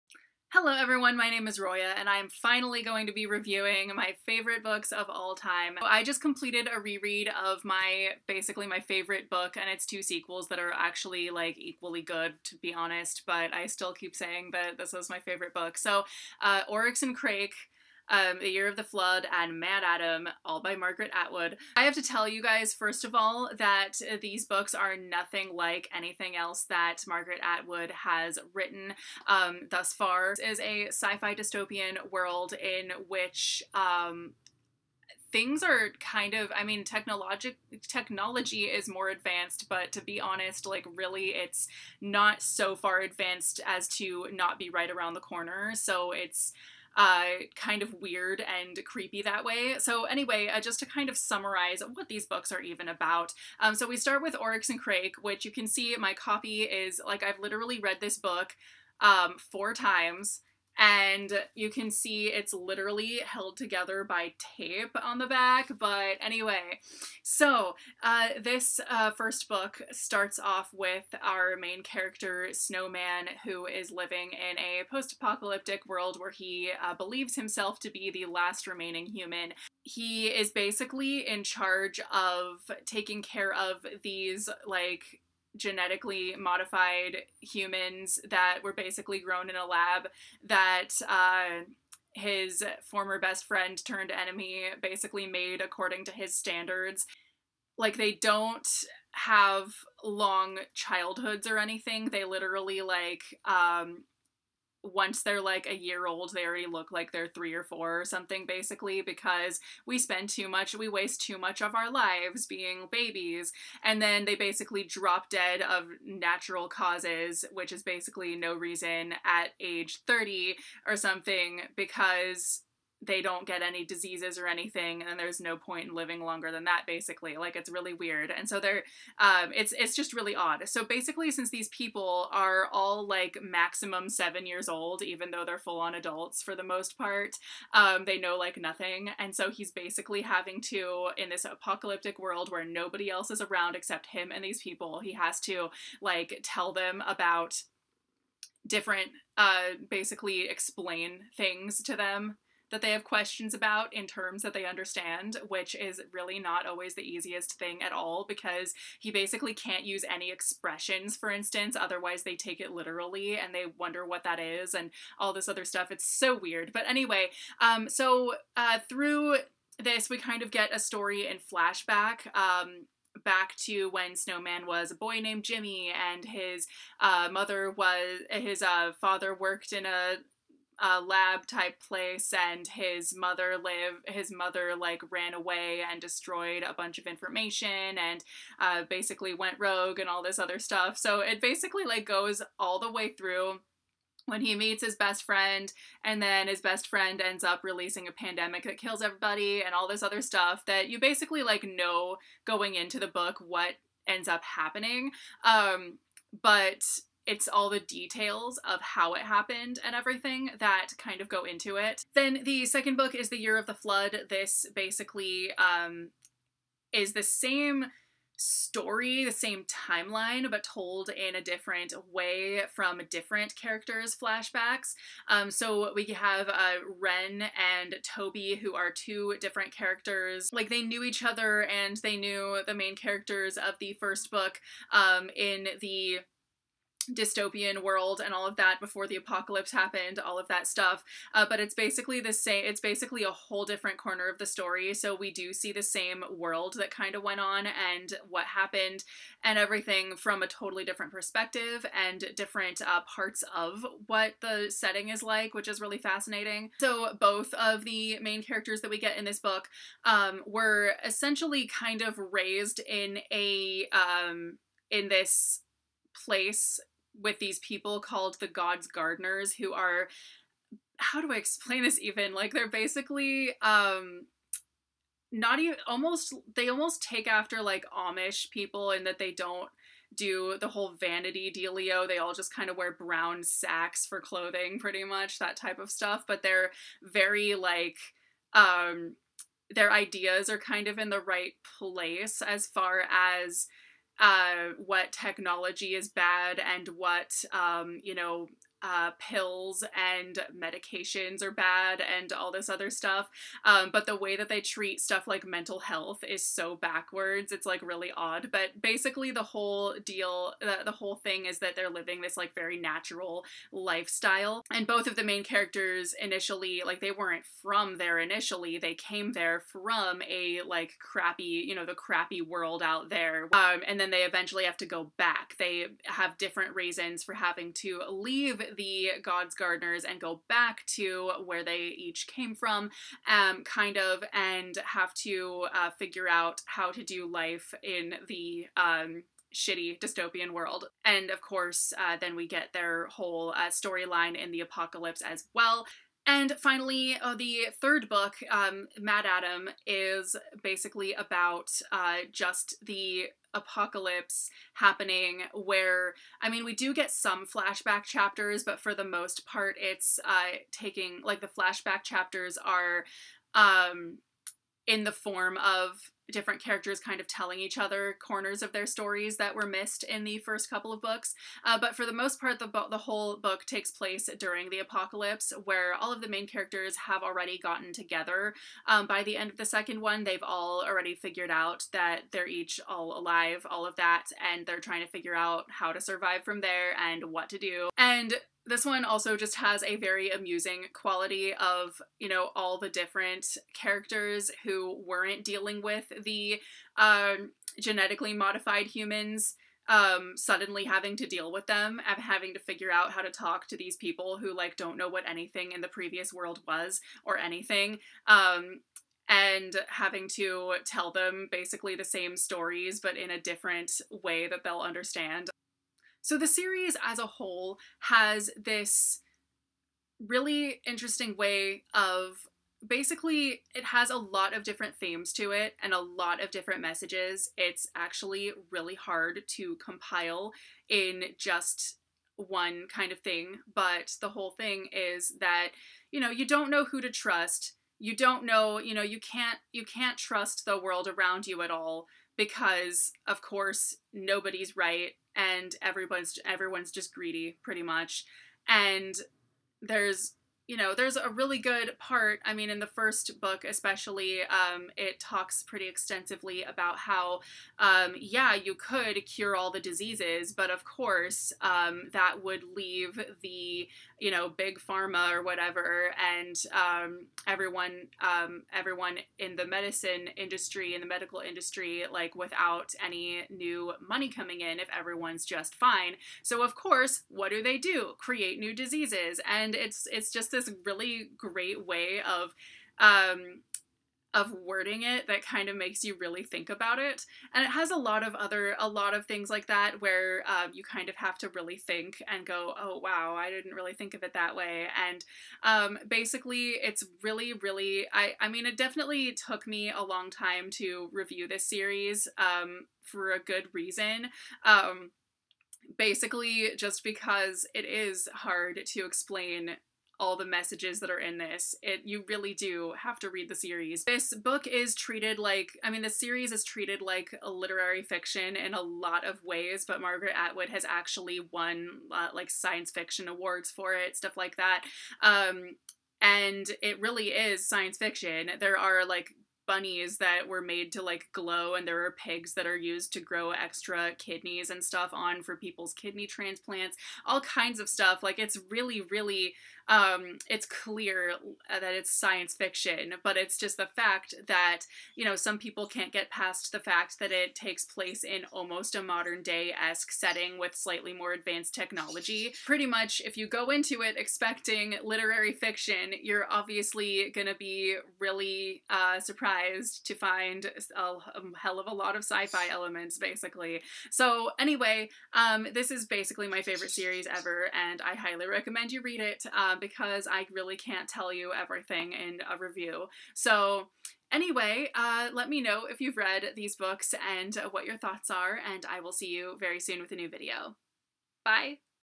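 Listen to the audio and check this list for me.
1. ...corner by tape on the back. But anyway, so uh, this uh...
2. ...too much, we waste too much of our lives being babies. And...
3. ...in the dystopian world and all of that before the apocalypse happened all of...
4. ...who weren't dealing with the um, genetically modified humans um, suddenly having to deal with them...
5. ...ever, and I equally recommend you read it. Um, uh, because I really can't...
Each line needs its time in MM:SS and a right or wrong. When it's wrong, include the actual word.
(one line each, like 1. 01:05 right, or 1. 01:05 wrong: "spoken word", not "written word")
1. 01:03 wrong: "together", not "corner"
2. 01:50 right
3. 03:55 right
4. 06:34 right
5. 09:27 wrong: "highly", not "equally".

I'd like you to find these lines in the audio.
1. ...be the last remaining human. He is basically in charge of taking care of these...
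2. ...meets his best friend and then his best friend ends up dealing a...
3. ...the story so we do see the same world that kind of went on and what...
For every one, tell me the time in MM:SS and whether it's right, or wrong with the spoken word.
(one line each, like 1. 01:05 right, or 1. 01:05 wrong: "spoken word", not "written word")
1. 01:17 right
2. 03:14 wrong: "releasing", not "dealing"
3. 04:04 right.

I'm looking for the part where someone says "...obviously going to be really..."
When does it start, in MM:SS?
09:16.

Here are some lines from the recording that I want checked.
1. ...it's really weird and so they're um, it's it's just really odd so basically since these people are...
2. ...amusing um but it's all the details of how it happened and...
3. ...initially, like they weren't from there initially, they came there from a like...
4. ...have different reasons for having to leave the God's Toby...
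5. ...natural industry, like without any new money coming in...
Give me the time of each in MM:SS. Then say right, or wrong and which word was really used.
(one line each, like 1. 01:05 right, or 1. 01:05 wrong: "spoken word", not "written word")
1. 02:07 right
2. 03:24 wrong: "happening", not "amusing"
3. 05:16 right
4. 05:26 wrong: "Gardeners", not "Toby"
5. 07:51 wrong: "medical", not "natural".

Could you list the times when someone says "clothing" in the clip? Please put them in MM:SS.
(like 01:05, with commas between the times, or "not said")
04:44.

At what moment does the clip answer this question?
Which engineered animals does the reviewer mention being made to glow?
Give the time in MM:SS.
08:49.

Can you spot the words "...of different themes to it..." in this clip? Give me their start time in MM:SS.
07:04.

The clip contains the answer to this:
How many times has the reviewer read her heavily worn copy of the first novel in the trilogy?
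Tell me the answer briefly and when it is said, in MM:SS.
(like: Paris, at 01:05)
4, at 00:59.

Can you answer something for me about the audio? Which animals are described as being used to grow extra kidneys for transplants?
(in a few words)
pigs.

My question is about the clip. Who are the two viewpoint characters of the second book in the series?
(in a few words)
Ren and Toby.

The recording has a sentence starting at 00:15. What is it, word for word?
So, uh, Oryx and Crake um, The Year of the Flood and MaddAddam, all by Margaret Atwood.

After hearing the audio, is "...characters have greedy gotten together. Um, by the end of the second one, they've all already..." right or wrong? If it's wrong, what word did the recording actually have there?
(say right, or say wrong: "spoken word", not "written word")
wrong: "already", not "greedy".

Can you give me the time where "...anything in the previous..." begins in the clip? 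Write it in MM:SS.
06:45.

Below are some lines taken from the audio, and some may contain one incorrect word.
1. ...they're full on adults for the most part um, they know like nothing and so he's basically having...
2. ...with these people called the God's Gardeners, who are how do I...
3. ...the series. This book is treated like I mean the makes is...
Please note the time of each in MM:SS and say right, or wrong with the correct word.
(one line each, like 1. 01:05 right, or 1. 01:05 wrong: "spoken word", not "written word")
1. 02:15 right
2. 04:27 right
3. 08:33 wrong: "series", not "makes".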